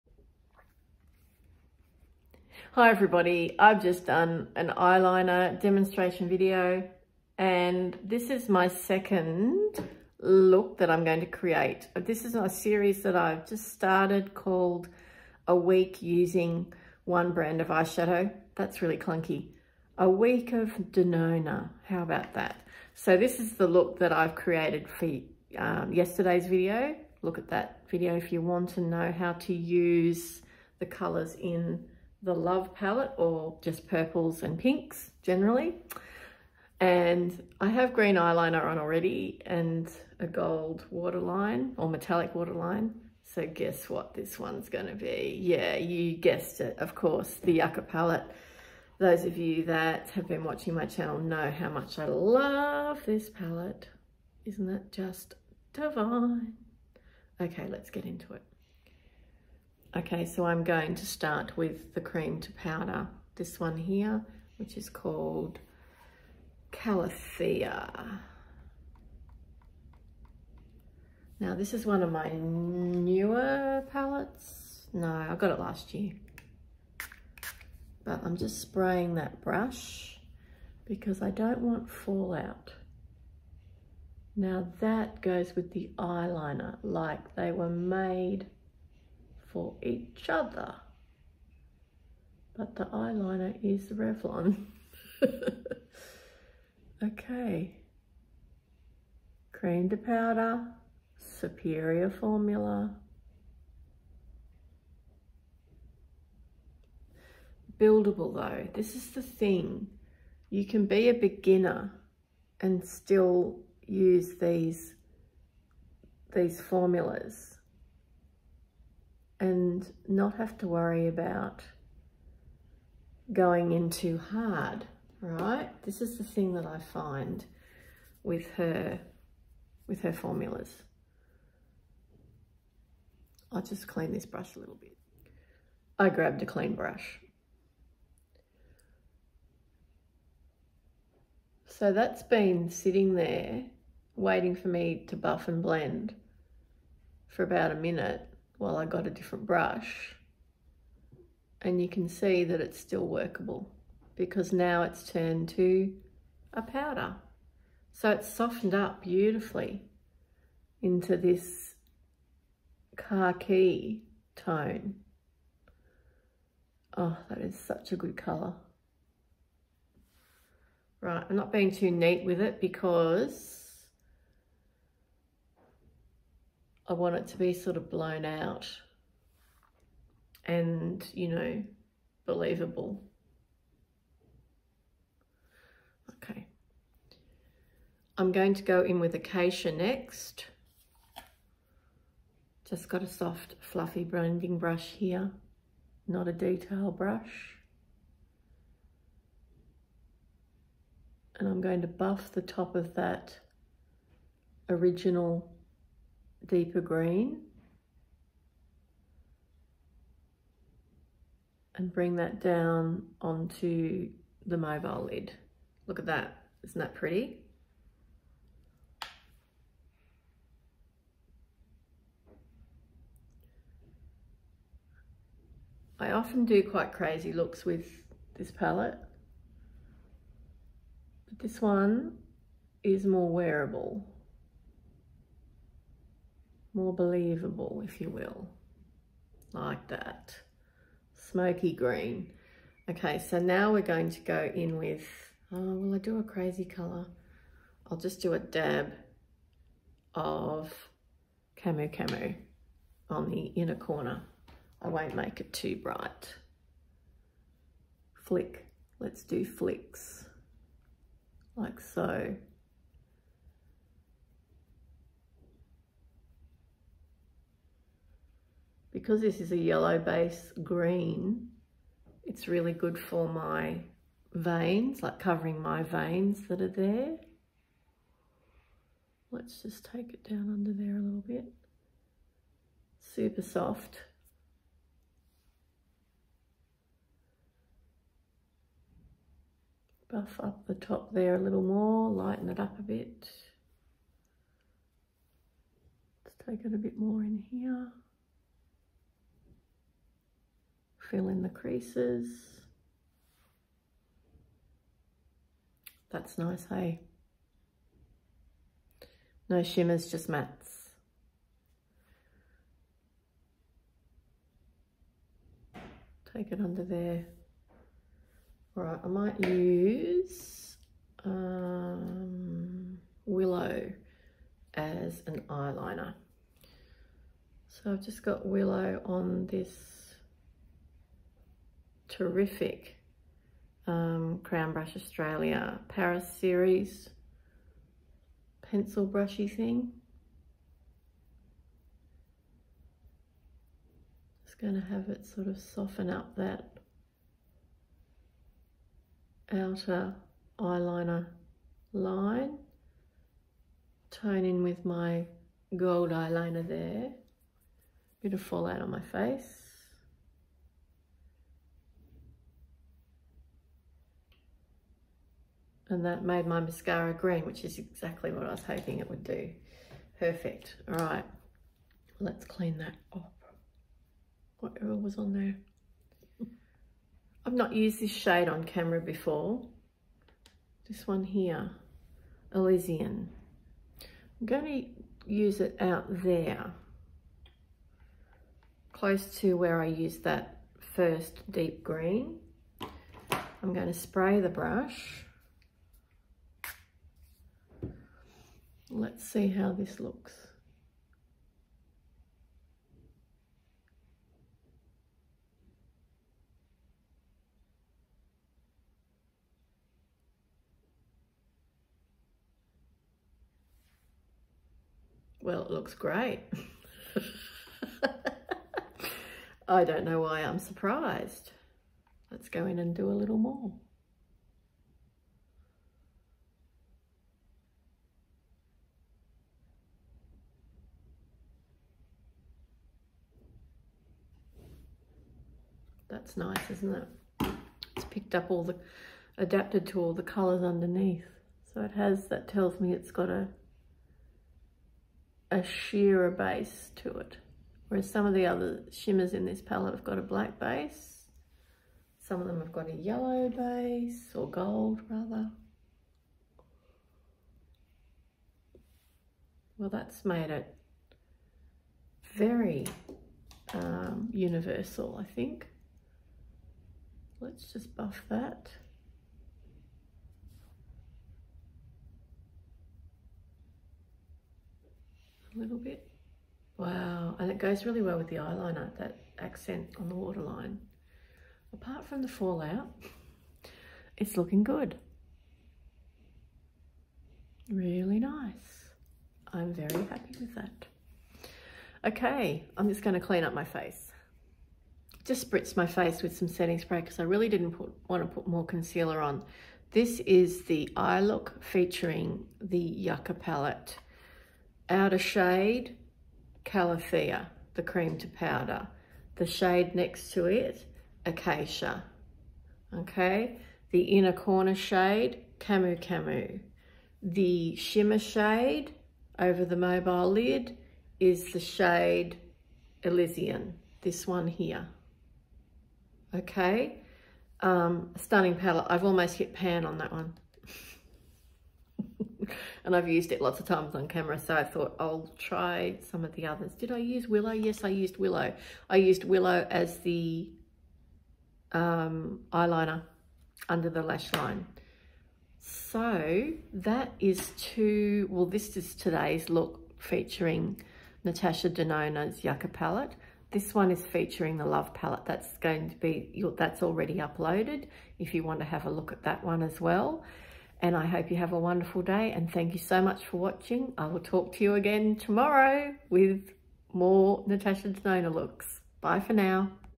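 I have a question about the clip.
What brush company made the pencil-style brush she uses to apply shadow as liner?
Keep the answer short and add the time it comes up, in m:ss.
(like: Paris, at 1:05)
Crown Brush Australia, at 5:34.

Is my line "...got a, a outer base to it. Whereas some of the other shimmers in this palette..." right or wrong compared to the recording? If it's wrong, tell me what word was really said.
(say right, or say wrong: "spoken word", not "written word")
wrong: "sheerer", not "outer".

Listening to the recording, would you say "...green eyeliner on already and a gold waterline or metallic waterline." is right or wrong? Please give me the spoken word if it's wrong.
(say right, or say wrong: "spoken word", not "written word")
right.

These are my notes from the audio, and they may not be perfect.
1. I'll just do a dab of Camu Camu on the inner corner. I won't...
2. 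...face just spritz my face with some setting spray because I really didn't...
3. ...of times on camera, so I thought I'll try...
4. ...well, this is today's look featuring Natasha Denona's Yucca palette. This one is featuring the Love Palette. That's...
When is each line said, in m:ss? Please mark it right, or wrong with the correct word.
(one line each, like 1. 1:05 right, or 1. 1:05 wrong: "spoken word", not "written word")
1. 4:07 right
2. 8:13 right
3. 8:53 right
4. 9:08 right.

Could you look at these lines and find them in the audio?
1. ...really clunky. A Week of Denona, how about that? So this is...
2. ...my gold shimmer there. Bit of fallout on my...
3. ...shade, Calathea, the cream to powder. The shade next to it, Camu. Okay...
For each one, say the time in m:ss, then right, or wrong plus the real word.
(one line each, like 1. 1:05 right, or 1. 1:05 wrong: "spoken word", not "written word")
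1. 0:18 right
2. 5:54 wrong: "eyeliner", not "shimmer"
3. 8:25 wrong: "Acacia", not "Camu".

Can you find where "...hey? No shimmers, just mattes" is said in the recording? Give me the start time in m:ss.
5:06.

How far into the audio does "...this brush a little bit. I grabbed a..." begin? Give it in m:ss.
2:14.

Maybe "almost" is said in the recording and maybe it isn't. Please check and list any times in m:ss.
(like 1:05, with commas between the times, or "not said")
8:49.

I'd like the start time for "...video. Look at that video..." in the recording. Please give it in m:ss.
0:26.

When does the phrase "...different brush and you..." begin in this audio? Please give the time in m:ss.
2:29.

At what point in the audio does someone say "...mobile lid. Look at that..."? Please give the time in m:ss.
3:34.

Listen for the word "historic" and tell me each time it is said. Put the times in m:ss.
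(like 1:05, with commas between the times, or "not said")
not said.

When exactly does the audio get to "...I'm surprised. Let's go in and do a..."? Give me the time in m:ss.
7:00.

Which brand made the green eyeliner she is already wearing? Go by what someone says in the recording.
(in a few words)
Revlon.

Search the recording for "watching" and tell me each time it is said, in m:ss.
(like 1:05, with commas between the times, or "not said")
0:50, 9:23.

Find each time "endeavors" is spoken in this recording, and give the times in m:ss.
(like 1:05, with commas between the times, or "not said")
not said.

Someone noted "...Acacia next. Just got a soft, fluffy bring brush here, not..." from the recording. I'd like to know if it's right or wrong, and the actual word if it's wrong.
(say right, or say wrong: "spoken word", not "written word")
wrong: "blending", not "bring".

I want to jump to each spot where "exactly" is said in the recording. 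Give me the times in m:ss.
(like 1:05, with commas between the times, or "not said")
6:07.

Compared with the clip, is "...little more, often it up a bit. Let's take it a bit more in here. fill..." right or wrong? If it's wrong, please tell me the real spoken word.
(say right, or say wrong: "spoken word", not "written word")
wrong: "lighten", not "often".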